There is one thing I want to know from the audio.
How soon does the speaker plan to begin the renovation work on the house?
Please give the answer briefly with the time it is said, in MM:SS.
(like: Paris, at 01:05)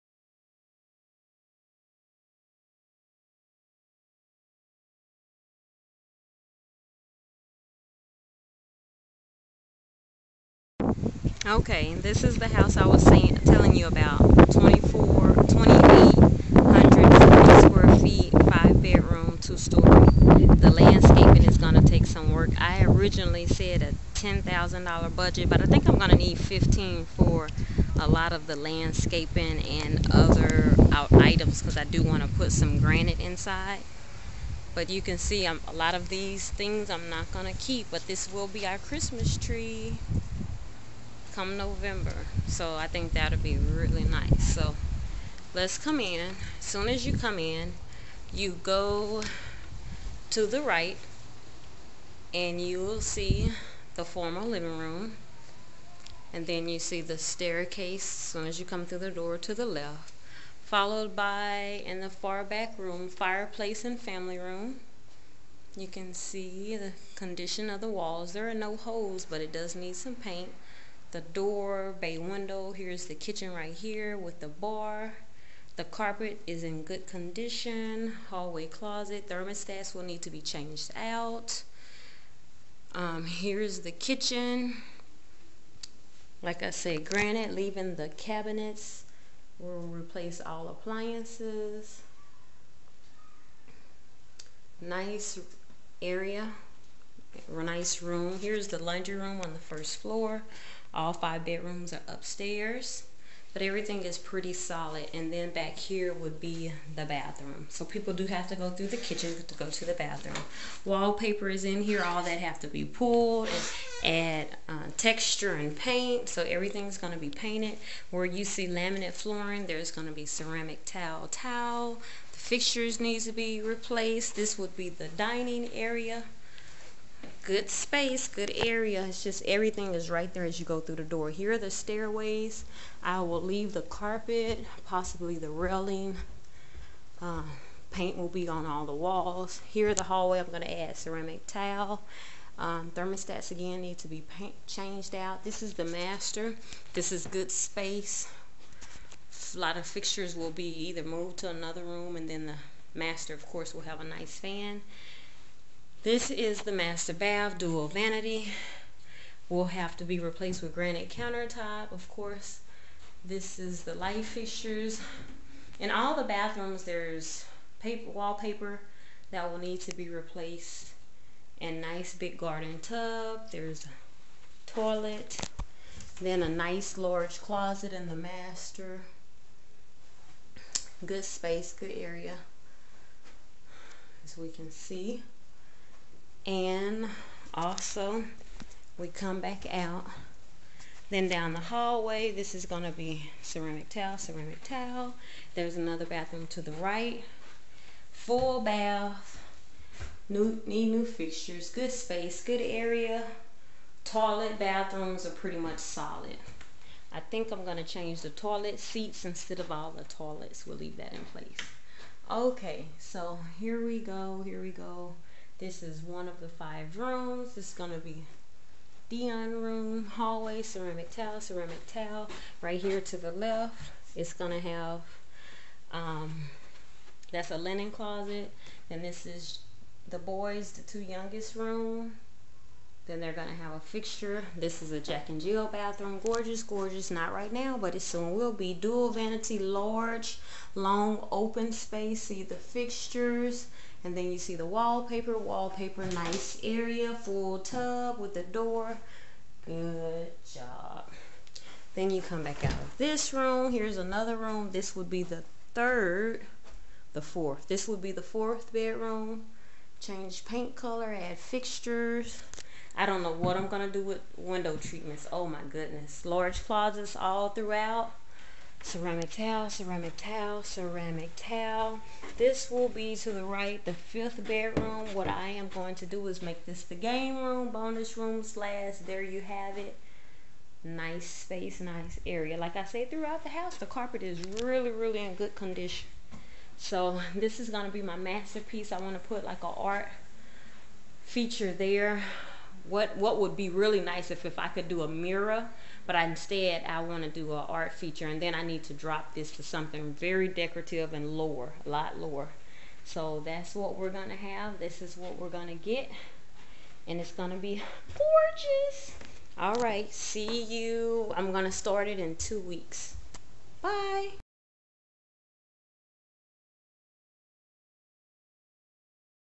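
In two weeks, at 05:12.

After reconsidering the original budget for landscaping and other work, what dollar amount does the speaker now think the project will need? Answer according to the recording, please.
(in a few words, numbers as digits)
$15,000.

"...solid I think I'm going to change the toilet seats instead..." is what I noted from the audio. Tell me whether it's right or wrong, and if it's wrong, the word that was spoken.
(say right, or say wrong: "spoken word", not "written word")
right.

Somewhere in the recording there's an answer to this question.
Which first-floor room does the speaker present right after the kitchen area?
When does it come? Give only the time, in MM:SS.
01:38.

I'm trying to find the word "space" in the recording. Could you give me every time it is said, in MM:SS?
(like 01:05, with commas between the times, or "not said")
02:07, 02:27, 03:01, 03:21, 04:01, 04:41.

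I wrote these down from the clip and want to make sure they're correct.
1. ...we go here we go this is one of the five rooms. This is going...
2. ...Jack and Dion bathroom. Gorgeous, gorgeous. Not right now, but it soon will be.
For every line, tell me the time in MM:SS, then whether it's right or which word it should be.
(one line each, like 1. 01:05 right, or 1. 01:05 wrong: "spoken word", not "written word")
1. 03:33 right
2. 03:55 wrong: "Jill", not "Dion".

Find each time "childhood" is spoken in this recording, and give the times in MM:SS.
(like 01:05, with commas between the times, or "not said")
not said.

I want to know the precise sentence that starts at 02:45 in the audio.
In all the bathrooms, there's paper, wallpaper that will need to be replaced.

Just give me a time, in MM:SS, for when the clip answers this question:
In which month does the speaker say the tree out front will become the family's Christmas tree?
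00:41.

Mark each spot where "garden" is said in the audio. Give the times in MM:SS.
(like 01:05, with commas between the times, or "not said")
02:52.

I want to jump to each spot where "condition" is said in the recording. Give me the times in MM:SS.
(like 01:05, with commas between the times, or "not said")
01:07, 01:17, 04:45.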